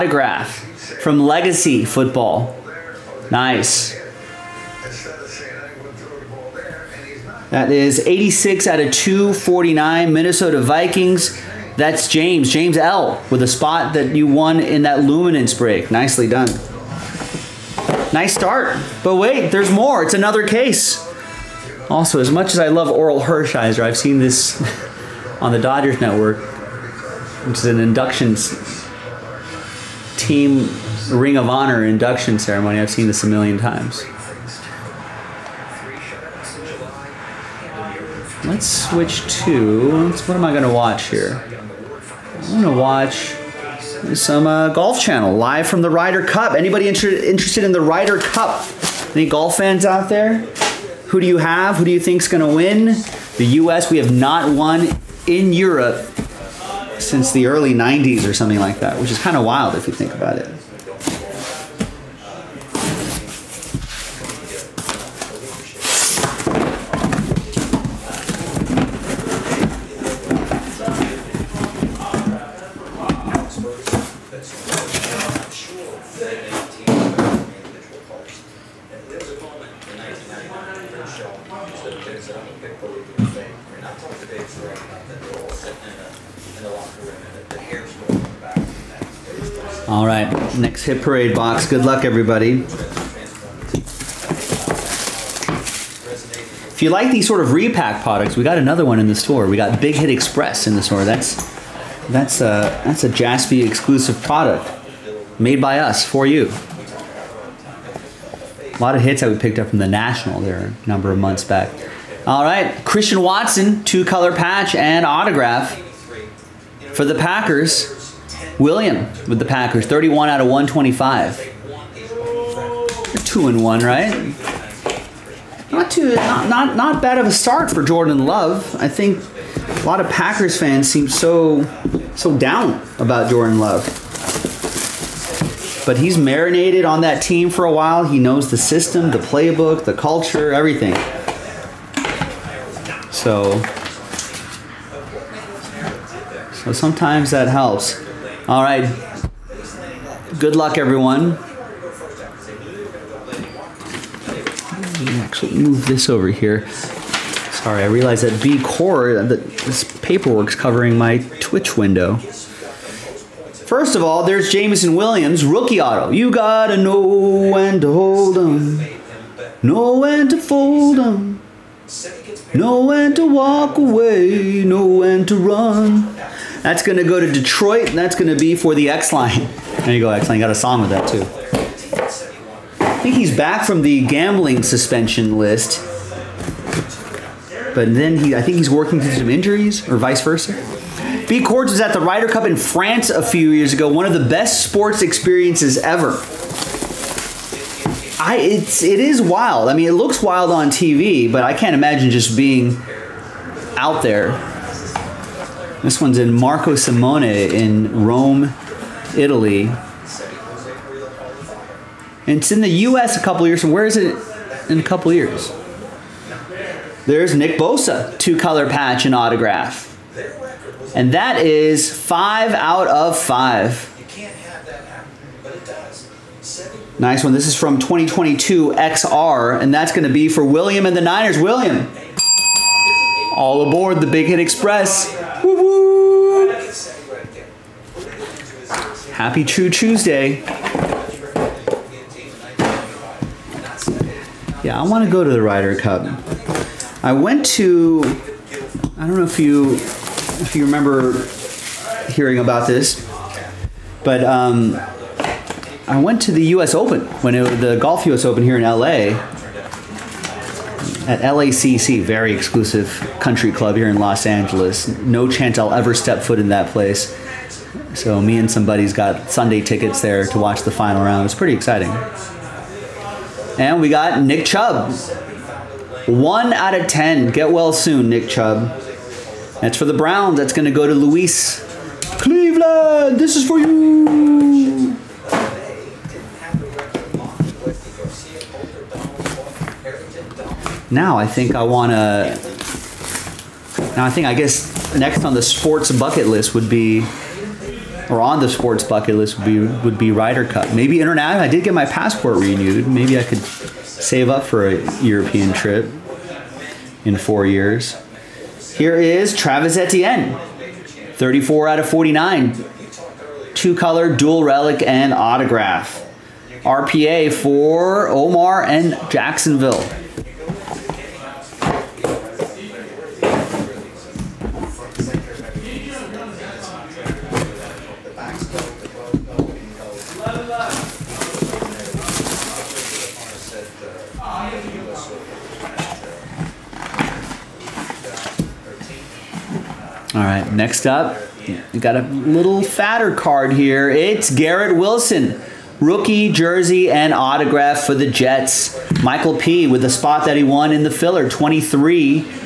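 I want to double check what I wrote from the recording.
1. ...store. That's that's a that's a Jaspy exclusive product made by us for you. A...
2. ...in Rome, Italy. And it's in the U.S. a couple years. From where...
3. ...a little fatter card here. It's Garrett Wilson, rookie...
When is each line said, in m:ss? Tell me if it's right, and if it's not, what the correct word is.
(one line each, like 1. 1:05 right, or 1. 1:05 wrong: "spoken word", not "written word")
1. 1:40 right
2. 3:27 right
3. 5:41 right.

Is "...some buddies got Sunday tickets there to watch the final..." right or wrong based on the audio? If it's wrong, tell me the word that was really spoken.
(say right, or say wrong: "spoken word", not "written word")
right.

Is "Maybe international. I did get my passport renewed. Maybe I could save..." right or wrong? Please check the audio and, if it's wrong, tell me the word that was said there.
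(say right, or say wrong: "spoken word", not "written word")
right.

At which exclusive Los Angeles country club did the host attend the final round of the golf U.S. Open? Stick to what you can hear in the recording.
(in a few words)
LACC.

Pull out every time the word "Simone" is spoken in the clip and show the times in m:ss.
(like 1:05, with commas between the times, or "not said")
3:26.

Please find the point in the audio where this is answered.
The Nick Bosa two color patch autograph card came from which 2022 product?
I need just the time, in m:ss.
3:48.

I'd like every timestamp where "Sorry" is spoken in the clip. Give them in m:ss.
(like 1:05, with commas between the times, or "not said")
2:36.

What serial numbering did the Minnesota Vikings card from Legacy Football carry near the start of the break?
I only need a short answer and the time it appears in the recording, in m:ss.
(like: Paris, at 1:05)
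86/249, at 0:08.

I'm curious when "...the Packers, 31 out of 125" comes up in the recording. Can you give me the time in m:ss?
1:59.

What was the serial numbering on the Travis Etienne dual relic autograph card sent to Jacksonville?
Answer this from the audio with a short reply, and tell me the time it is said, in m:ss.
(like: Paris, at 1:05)
34/49, at 5:11.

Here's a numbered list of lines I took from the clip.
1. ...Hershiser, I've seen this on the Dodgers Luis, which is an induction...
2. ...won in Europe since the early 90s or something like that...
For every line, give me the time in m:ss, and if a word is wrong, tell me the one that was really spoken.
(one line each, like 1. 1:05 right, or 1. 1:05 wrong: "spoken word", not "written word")
1. 0:23 wrong: "Network", not "Luis"
2. 0:54 right.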